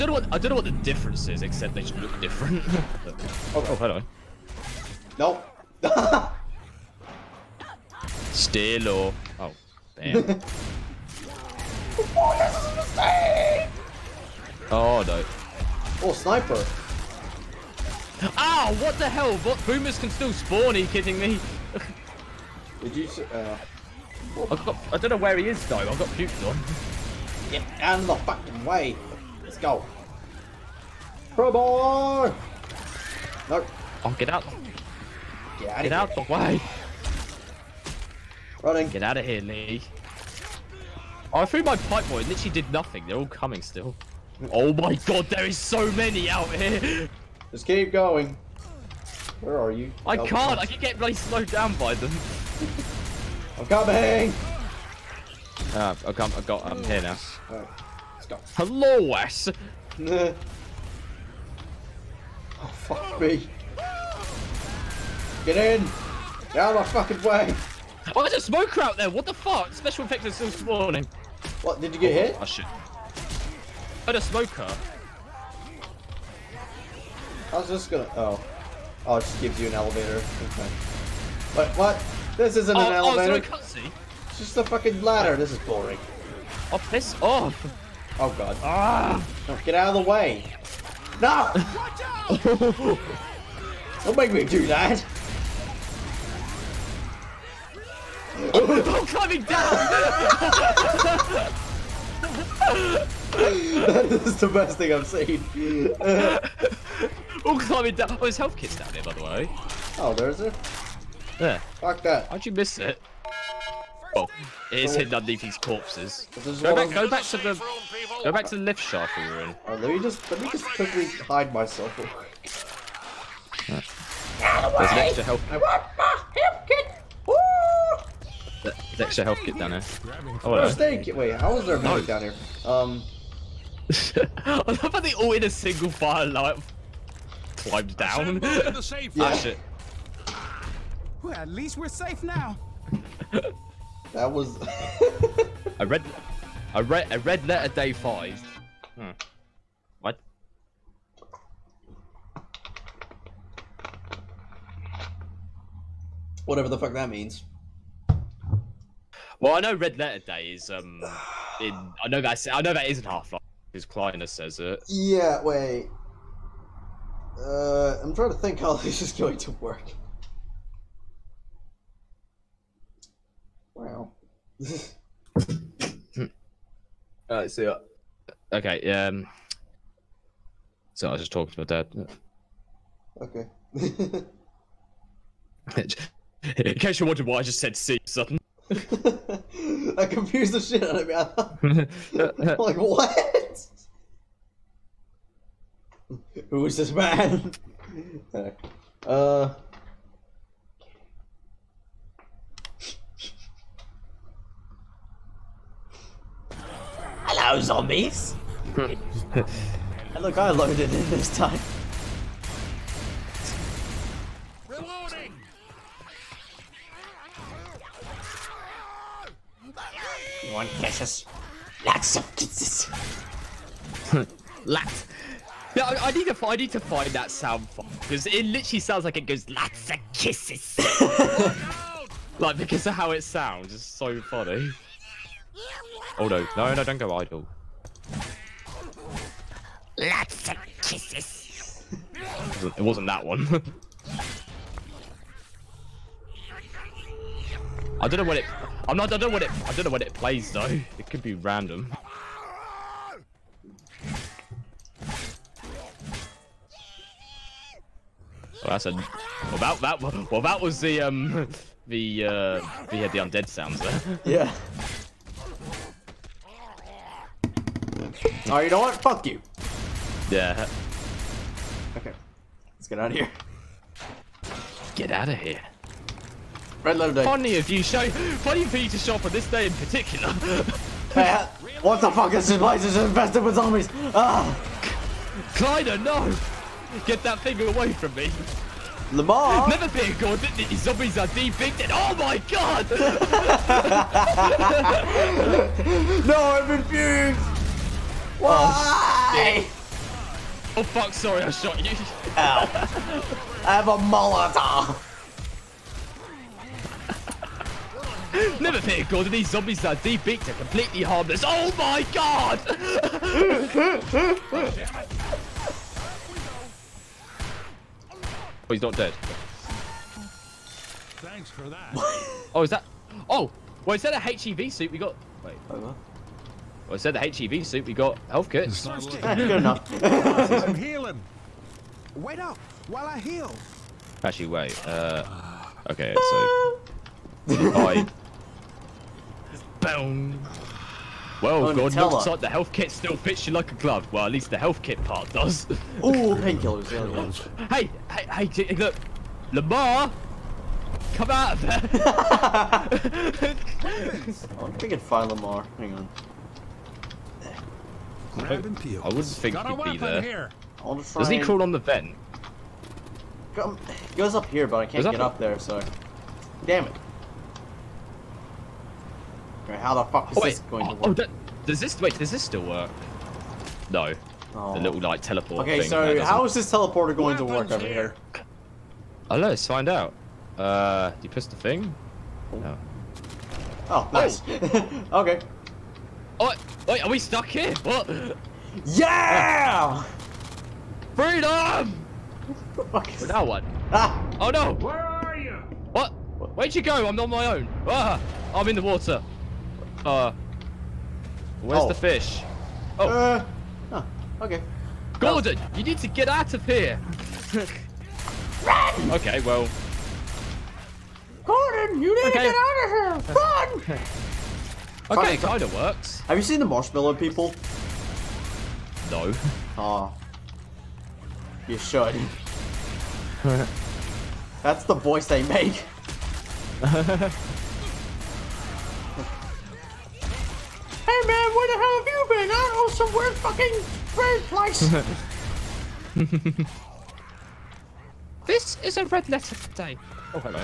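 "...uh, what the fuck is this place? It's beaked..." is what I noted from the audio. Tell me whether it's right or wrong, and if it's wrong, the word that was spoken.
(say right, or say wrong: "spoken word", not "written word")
wrong: "infested", not "beaked".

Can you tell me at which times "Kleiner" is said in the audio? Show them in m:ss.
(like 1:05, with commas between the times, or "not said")
2:43, 4:45.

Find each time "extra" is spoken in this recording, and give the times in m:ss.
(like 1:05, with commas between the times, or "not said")
2:04, 2:08.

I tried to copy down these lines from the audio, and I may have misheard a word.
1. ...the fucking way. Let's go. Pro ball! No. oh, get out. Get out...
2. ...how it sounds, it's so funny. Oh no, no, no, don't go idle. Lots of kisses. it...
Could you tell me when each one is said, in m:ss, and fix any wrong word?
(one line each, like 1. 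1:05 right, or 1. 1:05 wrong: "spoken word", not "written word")
1. 0:28 right
2. 3:52 right.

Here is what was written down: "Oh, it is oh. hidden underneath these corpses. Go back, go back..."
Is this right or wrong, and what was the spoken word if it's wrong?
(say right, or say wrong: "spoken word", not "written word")
right.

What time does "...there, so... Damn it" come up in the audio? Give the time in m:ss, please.
6:05.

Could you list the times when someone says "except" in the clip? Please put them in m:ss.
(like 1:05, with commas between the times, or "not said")
0:01.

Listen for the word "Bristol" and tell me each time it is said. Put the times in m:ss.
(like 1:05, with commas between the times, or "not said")
not said.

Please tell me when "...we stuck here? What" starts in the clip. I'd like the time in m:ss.
6:27.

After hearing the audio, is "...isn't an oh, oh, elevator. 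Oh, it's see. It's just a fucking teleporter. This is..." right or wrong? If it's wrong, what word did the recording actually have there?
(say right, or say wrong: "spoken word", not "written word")
wrong: "ladder", not "teleporter".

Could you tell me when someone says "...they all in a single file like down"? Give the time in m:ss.
2:14.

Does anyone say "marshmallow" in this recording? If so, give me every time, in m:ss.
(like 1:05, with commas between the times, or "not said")
6:56.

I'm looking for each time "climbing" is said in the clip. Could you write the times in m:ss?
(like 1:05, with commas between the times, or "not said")
1:39, 1:47.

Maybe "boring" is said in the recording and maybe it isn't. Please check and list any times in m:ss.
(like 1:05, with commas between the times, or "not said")
1:25.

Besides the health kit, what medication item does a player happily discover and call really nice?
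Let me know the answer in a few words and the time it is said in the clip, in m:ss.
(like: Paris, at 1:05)
Painkillers, at 5:46.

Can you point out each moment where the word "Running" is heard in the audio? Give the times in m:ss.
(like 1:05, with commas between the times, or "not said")
0:38.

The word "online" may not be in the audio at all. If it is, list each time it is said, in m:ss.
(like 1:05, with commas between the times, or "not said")
not said.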